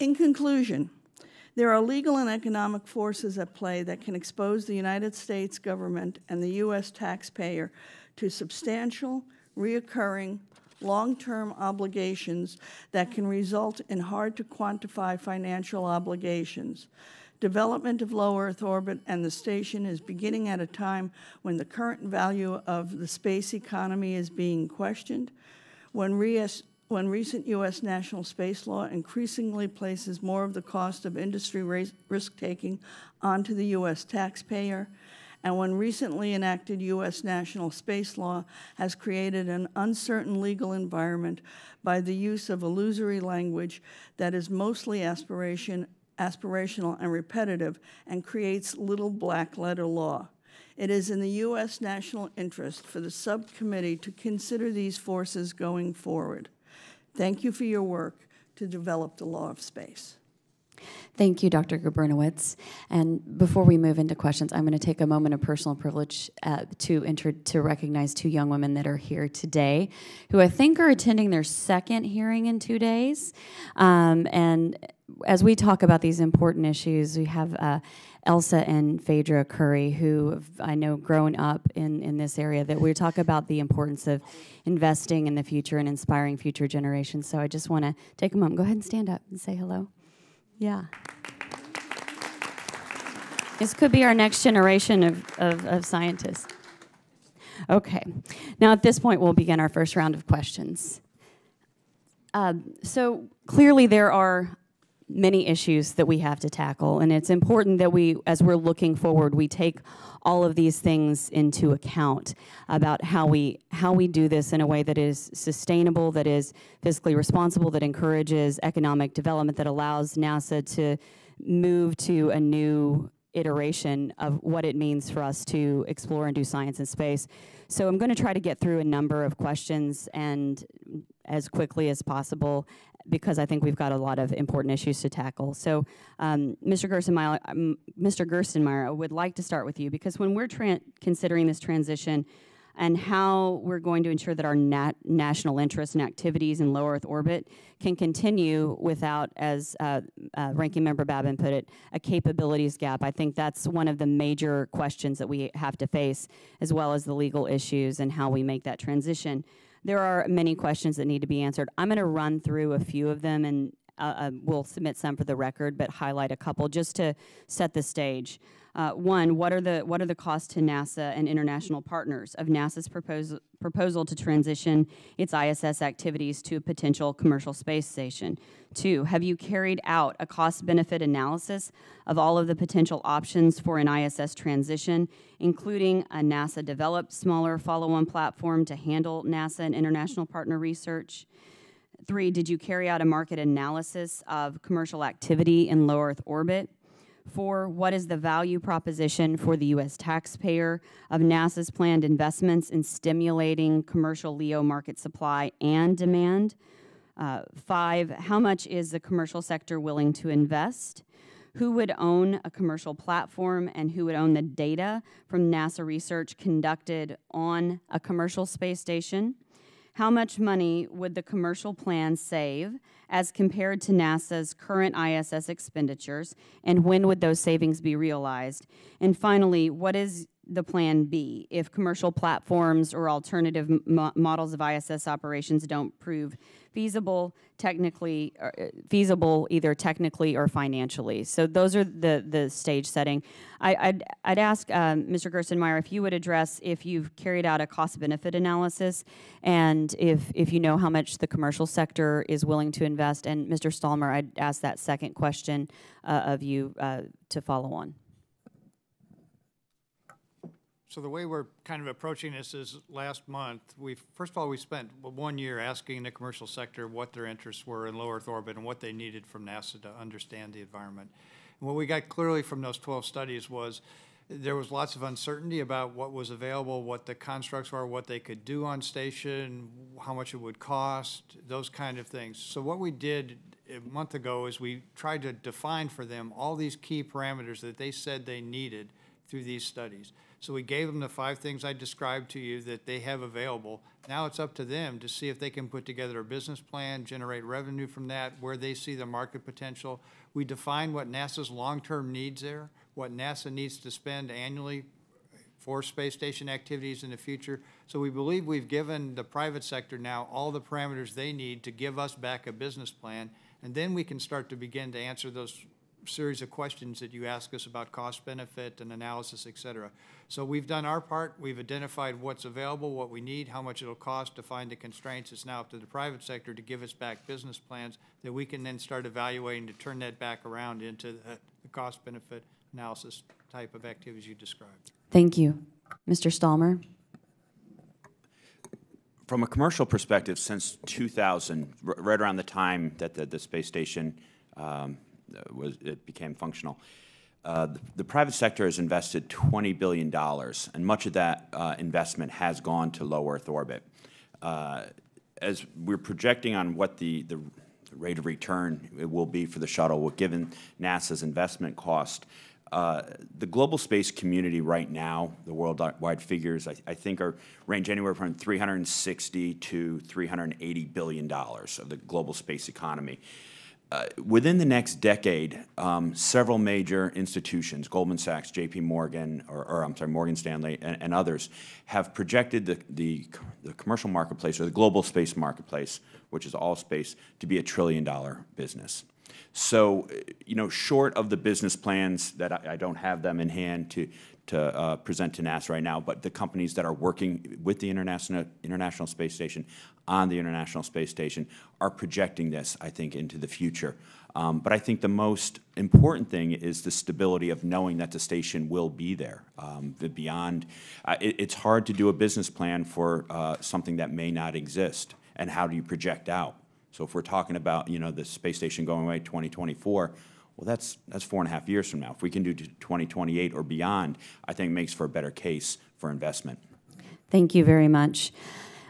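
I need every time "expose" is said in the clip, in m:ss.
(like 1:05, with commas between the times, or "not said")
0:04.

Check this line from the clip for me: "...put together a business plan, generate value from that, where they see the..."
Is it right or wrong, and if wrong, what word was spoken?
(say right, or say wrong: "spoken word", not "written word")
wrong: "revenue", not "value".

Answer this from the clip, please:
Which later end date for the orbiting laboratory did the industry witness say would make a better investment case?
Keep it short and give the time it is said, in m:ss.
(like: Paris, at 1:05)
2028, at 7:02.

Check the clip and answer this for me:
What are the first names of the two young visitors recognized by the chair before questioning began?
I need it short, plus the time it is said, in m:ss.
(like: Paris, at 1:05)
Elsa and Phaedra, at 1:18.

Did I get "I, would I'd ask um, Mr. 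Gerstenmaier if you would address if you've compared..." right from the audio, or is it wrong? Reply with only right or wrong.
wrong.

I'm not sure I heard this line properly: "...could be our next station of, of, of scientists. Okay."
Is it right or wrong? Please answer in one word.
wrong.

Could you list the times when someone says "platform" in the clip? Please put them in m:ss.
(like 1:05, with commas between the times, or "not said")
3:08, 3:32, 3:52.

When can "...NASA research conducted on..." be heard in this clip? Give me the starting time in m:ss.
3:35.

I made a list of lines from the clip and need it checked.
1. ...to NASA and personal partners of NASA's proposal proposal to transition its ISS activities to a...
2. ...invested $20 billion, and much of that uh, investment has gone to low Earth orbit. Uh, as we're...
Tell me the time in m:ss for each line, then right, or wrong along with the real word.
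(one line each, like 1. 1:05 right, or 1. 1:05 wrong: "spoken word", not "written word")
1. 2:50 wrong: "international", not "personal"
2. 5:48 right.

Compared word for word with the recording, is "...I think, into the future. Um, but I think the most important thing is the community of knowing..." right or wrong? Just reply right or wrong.
wrong.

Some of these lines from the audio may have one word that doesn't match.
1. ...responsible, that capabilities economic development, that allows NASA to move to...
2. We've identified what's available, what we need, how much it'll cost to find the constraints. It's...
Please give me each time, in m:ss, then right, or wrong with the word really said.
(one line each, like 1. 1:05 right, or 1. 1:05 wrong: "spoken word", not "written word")
1. 1:57 wrong: "encourages", not "capabilities"
2. 5:21 right.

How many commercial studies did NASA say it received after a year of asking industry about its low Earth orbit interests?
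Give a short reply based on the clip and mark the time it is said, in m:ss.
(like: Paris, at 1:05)
12, at 4:32.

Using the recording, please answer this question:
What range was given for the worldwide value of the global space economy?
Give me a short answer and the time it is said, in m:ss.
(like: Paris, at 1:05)
360 to 380 billion dollars, at 6:08.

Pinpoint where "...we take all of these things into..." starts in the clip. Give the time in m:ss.
1:49.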